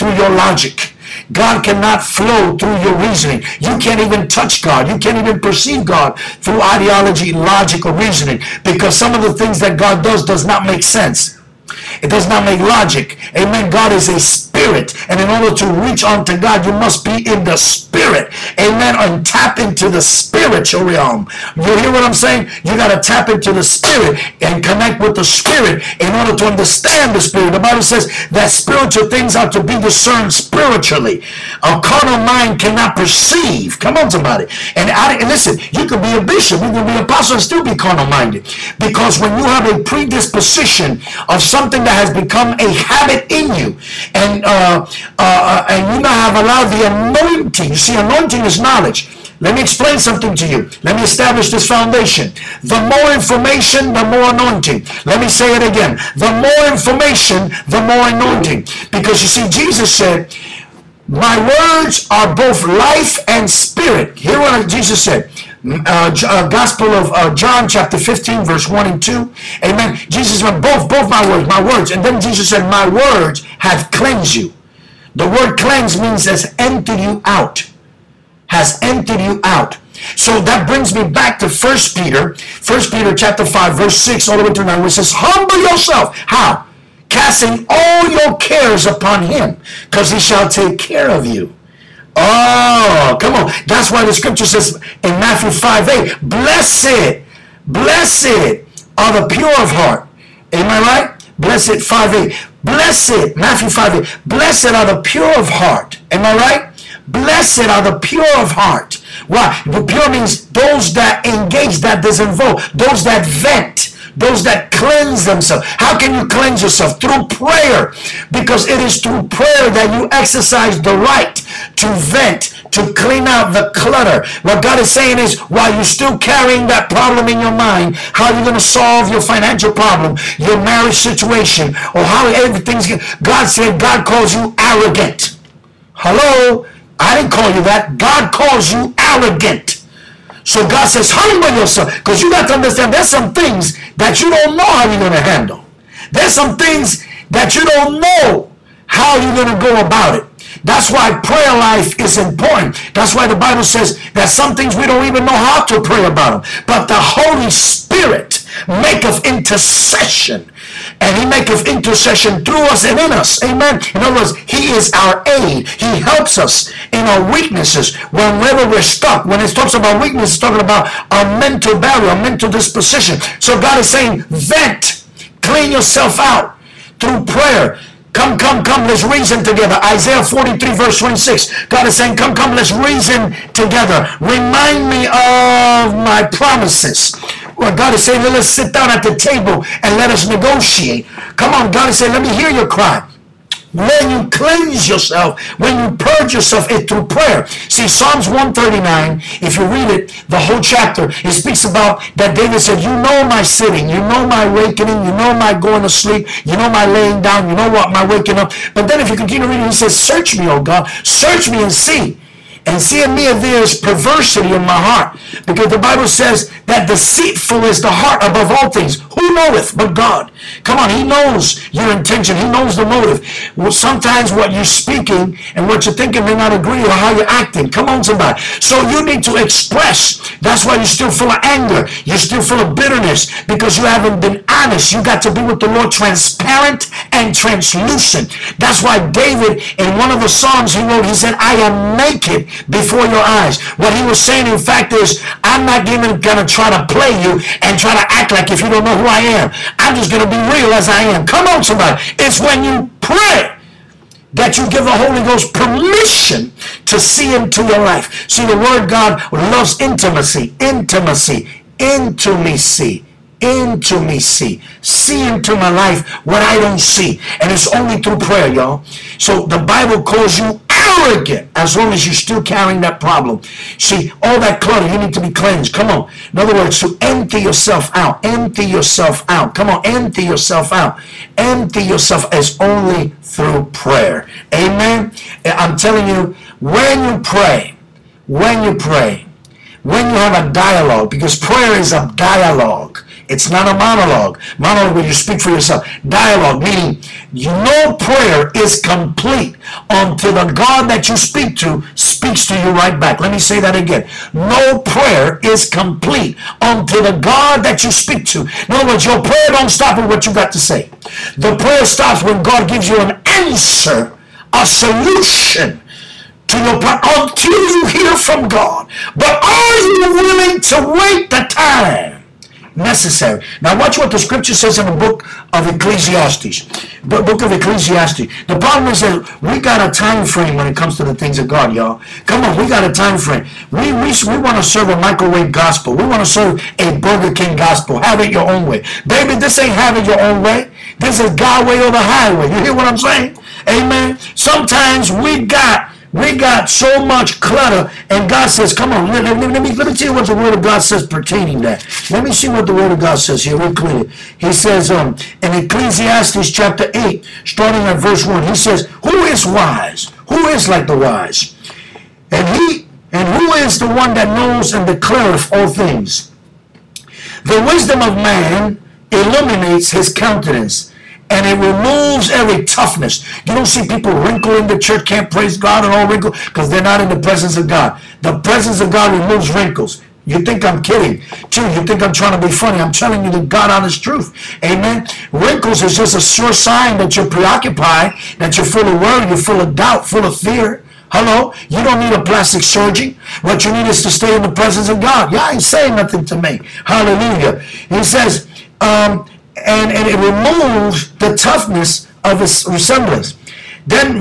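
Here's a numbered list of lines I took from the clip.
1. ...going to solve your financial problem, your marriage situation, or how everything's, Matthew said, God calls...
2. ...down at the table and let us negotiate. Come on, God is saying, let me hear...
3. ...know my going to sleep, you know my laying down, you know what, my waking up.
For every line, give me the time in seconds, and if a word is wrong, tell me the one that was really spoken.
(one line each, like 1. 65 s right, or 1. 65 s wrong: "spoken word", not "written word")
1. 128 s wrong: "God", not "Matthew"
2. 188 s right
3. 205 s right.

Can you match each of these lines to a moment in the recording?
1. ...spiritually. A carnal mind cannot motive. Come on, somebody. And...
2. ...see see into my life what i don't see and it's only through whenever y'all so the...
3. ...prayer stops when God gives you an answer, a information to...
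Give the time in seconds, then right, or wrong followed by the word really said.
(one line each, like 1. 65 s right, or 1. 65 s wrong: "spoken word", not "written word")
1. 30 s wrong: "perceive", not "motive"
2. 264 s wrong: "prayer", not "whenever"
3. 311 s wrong: "solution", not "information".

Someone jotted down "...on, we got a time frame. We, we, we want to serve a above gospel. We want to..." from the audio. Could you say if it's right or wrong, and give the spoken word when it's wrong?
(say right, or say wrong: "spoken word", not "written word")
wrong: "microwave", not "above".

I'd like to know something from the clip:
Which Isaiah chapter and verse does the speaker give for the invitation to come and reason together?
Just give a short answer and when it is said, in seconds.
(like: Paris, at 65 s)
Isaiah 43:26, at 179 s.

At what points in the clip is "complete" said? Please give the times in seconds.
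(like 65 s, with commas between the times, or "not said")
298 s, 305 s.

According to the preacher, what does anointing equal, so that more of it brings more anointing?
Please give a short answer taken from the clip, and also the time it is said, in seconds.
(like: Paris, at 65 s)
knowledge, at 47 s.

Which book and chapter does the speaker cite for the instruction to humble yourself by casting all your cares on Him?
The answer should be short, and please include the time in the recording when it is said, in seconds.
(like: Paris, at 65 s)
First Peter chapter 5, at 82 s.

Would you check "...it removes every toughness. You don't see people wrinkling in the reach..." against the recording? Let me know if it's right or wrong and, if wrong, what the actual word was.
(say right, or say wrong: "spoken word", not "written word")
wrong: "church", not "reach".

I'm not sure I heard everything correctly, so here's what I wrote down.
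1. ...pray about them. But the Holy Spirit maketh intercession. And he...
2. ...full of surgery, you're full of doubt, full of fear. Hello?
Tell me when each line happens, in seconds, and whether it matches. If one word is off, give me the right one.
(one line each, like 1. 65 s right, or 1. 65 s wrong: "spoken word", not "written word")
1. 155 s right
2. 388 s wrong: "worry", not "surgery".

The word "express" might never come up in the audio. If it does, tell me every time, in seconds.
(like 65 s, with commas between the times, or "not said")
229 s.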